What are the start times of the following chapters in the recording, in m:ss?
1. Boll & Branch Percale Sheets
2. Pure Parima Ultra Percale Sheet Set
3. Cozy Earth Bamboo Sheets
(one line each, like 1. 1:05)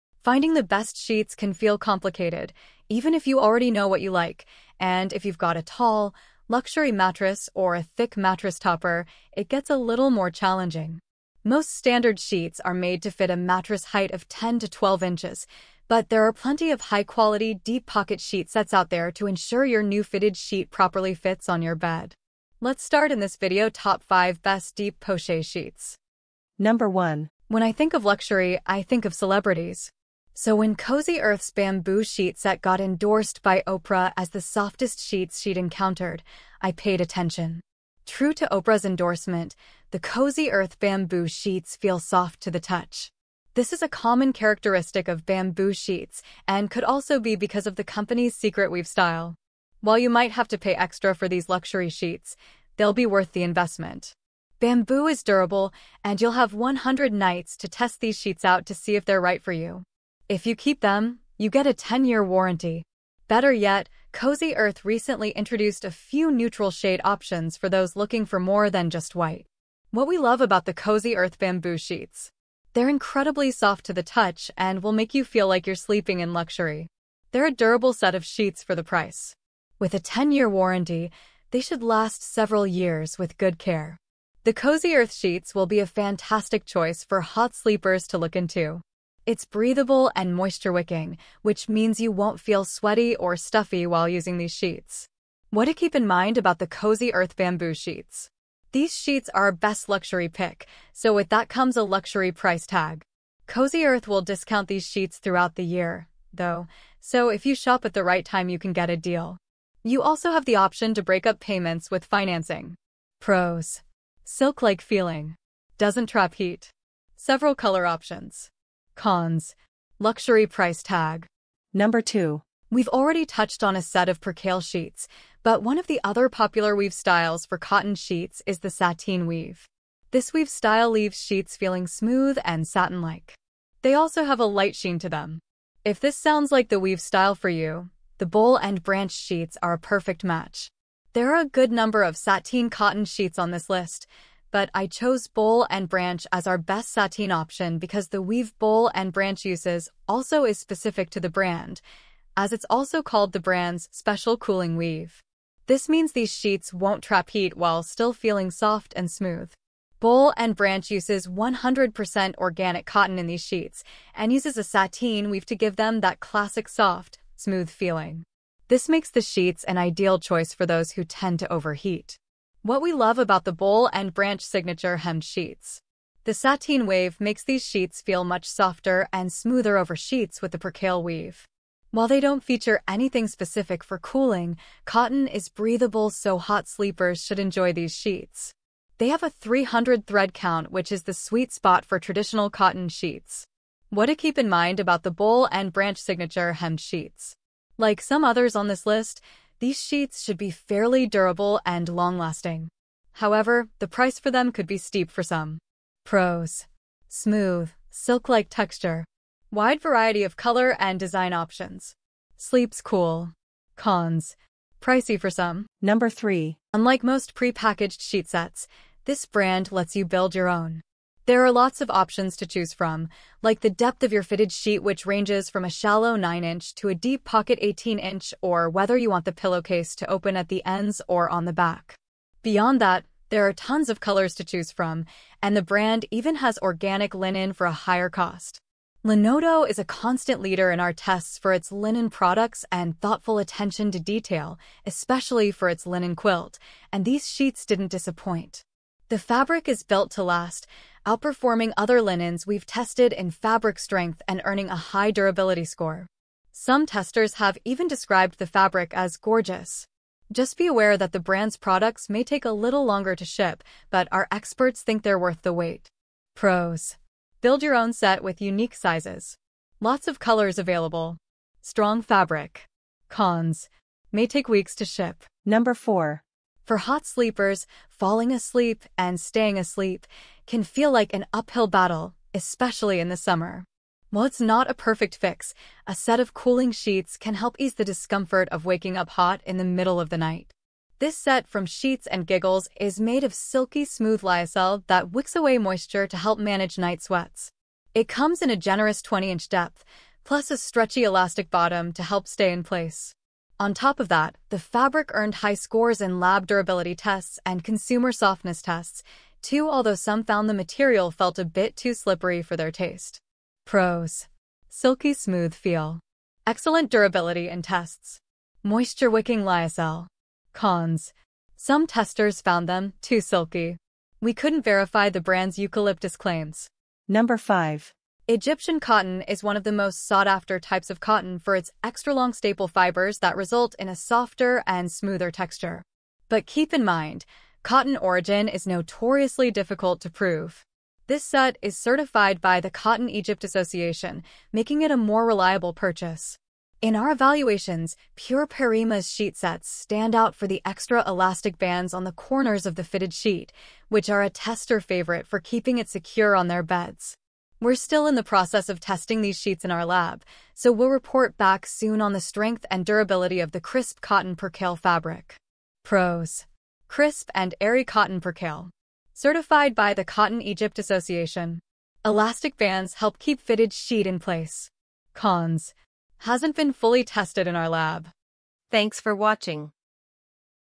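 1. 2:01
2. 5:27
3. 0:26.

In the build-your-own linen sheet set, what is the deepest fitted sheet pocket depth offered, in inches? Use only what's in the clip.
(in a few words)
18-inch.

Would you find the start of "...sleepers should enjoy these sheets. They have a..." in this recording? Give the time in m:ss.
3:06.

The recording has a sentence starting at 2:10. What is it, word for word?
This weave style leaves sheets feeling smooth and satin-like.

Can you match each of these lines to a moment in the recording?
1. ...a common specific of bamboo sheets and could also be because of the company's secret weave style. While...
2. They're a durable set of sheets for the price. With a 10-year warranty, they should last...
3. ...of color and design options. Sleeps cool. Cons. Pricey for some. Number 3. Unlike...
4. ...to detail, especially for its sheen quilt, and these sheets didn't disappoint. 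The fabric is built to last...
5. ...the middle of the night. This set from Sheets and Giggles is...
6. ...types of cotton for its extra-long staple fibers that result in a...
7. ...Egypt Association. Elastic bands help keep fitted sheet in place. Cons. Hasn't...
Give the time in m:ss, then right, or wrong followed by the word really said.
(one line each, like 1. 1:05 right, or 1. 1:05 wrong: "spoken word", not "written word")
1. 0:43 wrong: "characteristic", not "specific"
2. 1:17 right
3. 3:30 right
4. 4:03 wrong: "linen", not "sheen"
5. 4:49 right
6. 5:30 right
7. 6:10 right.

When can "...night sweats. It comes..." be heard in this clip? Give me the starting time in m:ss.
4:56.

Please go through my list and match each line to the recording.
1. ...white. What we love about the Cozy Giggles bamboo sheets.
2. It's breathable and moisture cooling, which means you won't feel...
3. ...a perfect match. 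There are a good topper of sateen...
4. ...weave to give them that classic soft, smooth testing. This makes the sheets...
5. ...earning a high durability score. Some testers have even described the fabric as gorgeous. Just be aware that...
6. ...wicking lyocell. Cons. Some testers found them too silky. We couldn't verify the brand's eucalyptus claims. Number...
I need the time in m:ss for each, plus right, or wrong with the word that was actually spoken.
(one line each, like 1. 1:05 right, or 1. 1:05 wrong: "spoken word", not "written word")
1. 1:09 wrong: "Earth", not "Giggles"
2. 1:29 wrong: "wicking", not "cooling"
3. 2:19 wrong: "number", not "topper"
4. 2:45 wrong: "feeling", not "testing"
5. 4:14 right
6. 5:19 right.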